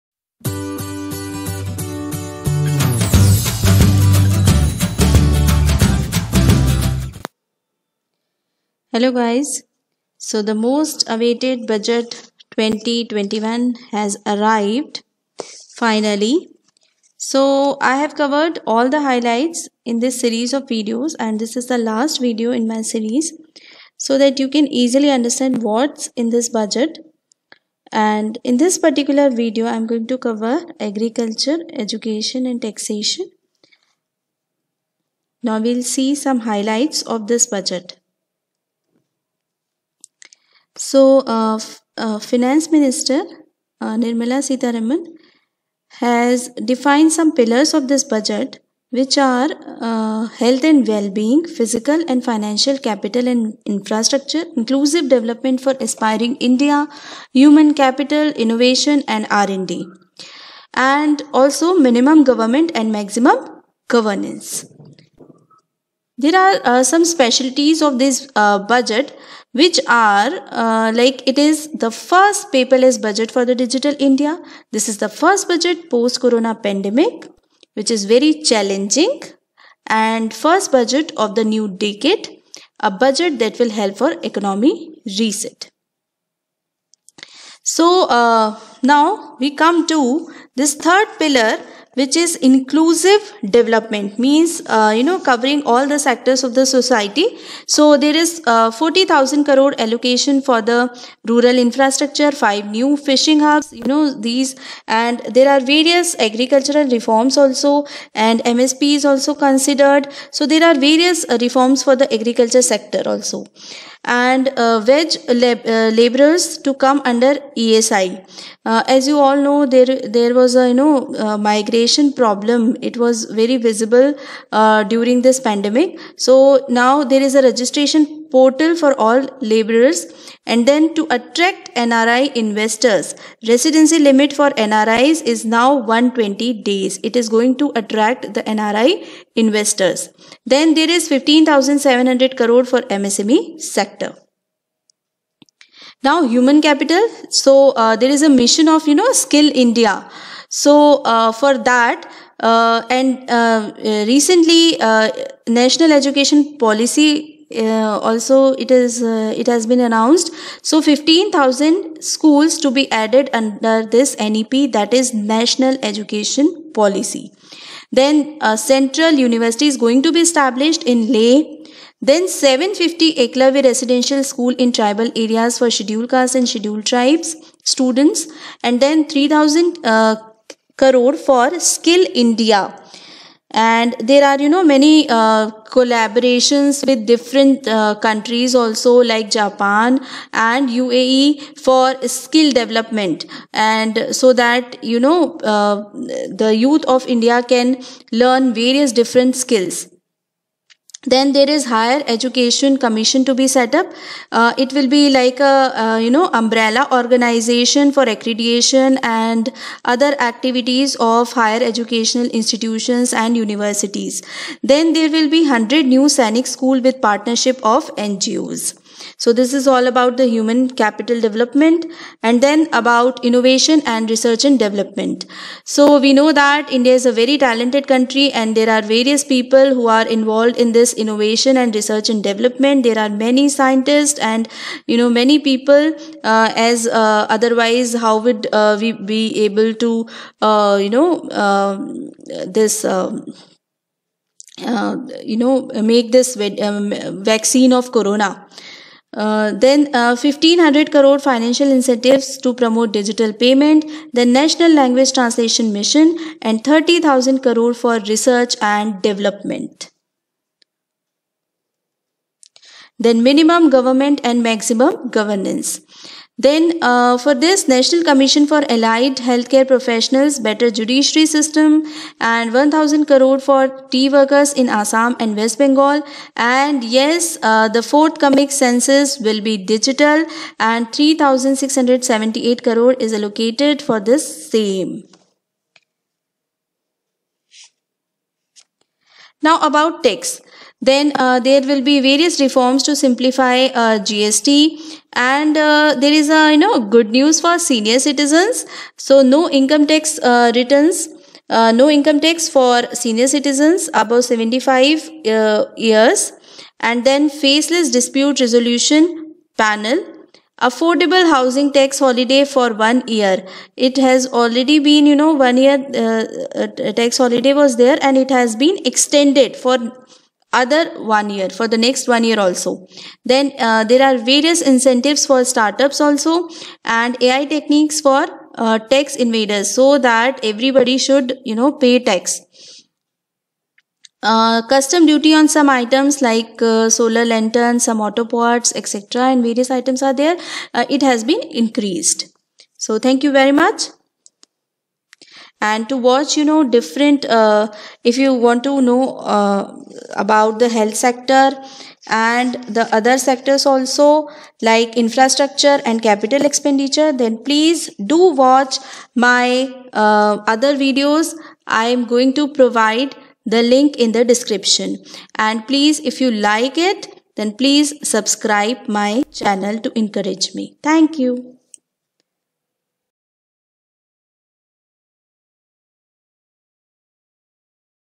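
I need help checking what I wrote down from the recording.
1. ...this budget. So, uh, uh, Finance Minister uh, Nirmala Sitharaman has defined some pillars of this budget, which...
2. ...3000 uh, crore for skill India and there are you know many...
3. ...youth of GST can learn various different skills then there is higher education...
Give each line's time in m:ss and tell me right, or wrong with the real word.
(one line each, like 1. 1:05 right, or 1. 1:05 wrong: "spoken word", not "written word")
1. 0:37 right
2. 2:59 right
3. 3:16 wrong: "India", not "GST".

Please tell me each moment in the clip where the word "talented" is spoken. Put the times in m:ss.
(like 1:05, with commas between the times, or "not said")
3:47.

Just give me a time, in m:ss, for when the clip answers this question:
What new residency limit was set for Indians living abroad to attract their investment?
2:15.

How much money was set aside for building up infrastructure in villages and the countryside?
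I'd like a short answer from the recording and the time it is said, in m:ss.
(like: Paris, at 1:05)
40000 crore, at 1:38.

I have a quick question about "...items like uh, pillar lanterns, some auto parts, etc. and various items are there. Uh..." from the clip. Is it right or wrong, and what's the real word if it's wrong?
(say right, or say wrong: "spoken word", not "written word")
wrong: "solar", not "pillar".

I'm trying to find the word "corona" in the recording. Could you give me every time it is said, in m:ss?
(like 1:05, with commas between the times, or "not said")
1:16, 4:07.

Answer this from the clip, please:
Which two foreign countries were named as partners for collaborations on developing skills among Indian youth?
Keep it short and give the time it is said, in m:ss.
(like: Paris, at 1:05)
Japan and UAE, at 3:09.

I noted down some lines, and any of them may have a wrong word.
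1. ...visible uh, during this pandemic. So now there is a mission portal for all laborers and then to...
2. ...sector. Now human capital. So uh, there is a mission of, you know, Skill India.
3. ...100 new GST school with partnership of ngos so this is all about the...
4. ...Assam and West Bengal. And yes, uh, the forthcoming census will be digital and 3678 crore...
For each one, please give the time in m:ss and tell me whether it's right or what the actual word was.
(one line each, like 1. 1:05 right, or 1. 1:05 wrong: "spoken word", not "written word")
1. 2:03 wrong: "registration", not "mission"
2. 2:23 right
3. 3:35 wrong: "Sainik", not "GST"
4. 4:34 right.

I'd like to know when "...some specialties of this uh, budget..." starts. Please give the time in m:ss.
1:06.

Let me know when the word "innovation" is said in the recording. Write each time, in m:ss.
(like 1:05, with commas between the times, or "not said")
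0:58, 3:43, 3:50.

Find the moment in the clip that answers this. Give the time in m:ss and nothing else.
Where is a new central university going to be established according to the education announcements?
2:51.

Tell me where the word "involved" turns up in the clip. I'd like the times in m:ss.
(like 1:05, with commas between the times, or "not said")
3:50.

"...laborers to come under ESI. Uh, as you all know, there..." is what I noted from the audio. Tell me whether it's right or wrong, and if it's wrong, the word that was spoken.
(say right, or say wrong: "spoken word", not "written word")
right.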